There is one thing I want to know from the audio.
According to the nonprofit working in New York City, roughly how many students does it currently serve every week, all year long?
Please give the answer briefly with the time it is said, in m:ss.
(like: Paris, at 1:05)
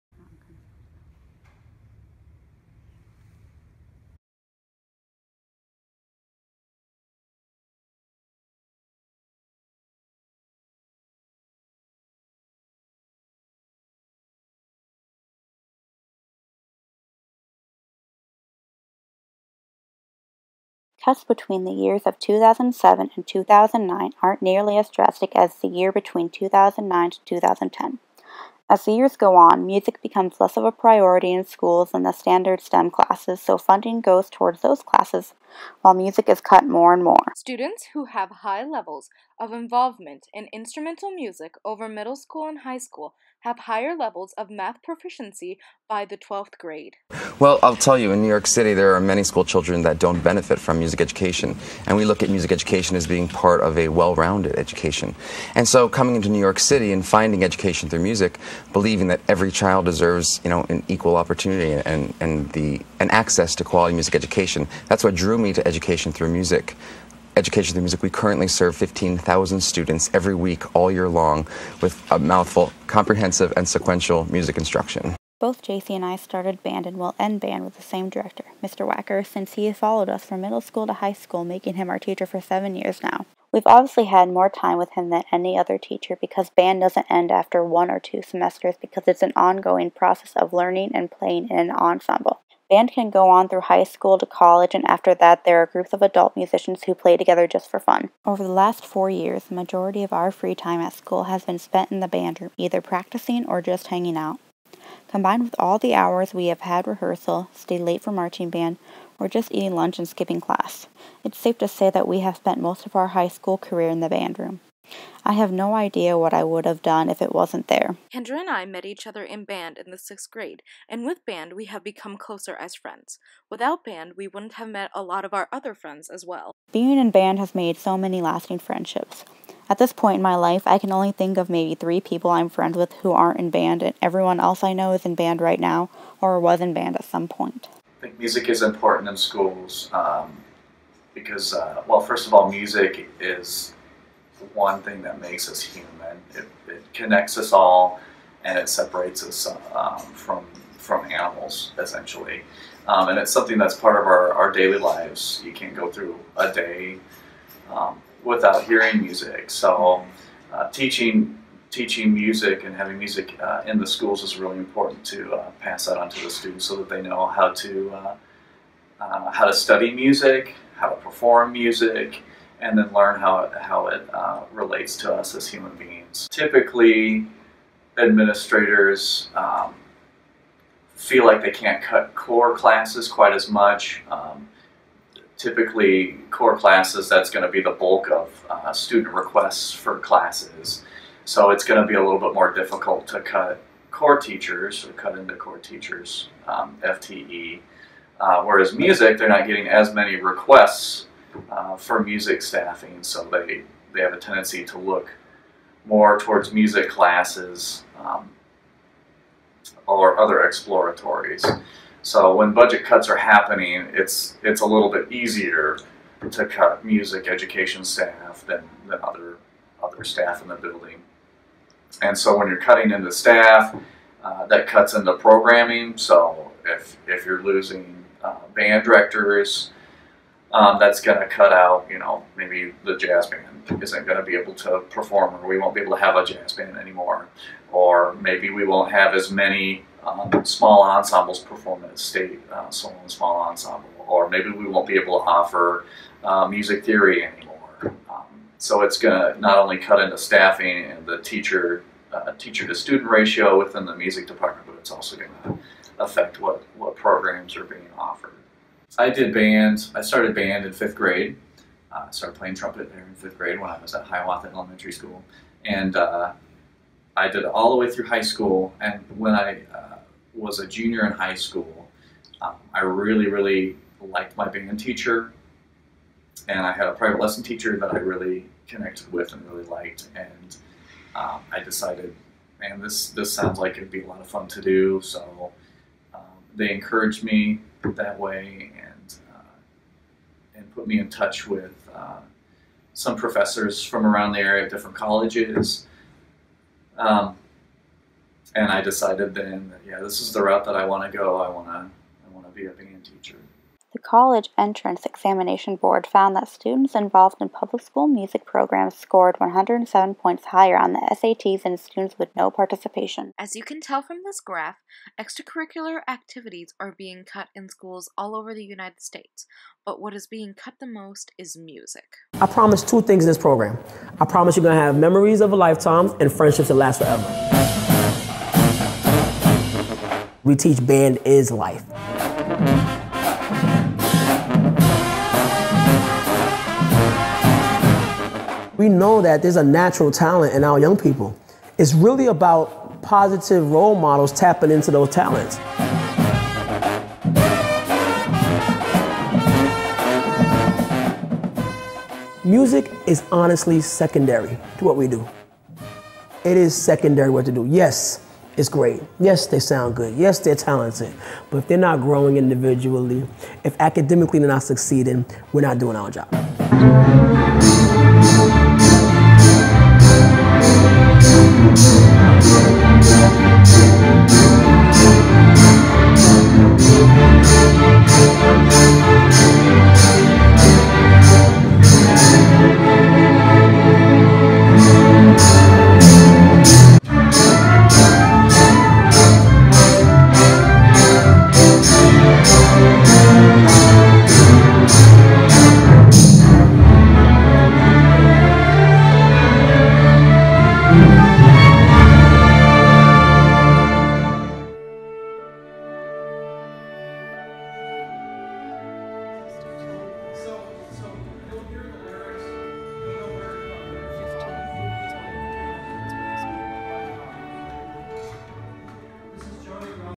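15,000, at 1:08.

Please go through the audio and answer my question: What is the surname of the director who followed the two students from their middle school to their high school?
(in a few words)
Wacker.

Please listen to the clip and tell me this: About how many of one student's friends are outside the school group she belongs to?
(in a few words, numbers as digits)
3.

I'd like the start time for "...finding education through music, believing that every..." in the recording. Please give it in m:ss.
0:57.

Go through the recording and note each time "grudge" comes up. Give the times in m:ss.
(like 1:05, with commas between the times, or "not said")
not said.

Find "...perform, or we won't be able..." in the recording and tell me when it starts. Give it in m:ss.
3:54.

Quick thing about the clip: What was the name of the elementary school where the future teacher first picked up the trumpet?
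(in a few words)
Hiawatha Elementary School.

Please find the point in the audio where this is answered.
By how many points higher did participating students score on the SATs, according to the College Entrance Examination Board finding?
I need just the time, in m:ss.
5:09.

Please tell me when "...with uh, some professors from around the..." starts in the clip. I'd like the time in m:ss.
4:51.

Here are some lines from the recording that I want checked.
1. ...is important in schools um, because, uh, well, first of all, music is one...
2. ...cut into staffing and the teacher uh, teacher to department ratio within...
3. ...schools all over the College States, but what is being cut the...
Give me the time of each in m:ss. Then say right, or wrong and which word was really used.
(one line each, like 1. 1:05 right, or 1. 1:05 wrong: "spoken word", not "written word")
1. 2:18 right
2. 4:09 wrong: "student", not "department"
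3. 5:17 wrong: "United", not "College".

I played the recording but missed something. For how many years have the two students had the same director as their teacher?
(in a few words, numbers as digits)
7.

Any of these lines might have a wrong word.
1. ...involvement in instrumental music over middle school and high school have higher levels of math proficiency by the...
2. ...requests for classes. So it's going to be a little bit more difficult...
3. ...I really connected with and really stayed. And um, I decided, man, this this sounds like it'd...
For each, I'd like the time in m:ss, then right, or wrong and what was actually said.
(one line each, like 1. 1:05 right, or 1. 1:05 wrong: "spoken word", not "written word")
1. 0:39 right
2. 3:09 right
3. 4:37 wrong: "liked", not "stayed".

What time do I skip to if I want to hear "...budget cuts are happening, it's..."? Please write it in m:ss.
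3:32.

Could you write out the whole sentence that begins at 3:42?
And so when you're cutting into staff, uh, that cuts into programming.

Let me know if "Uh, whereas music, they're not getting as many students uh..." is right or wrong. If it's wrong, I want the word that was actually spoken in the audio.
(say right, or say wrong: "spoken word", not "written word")
wrong: "requests", not "students".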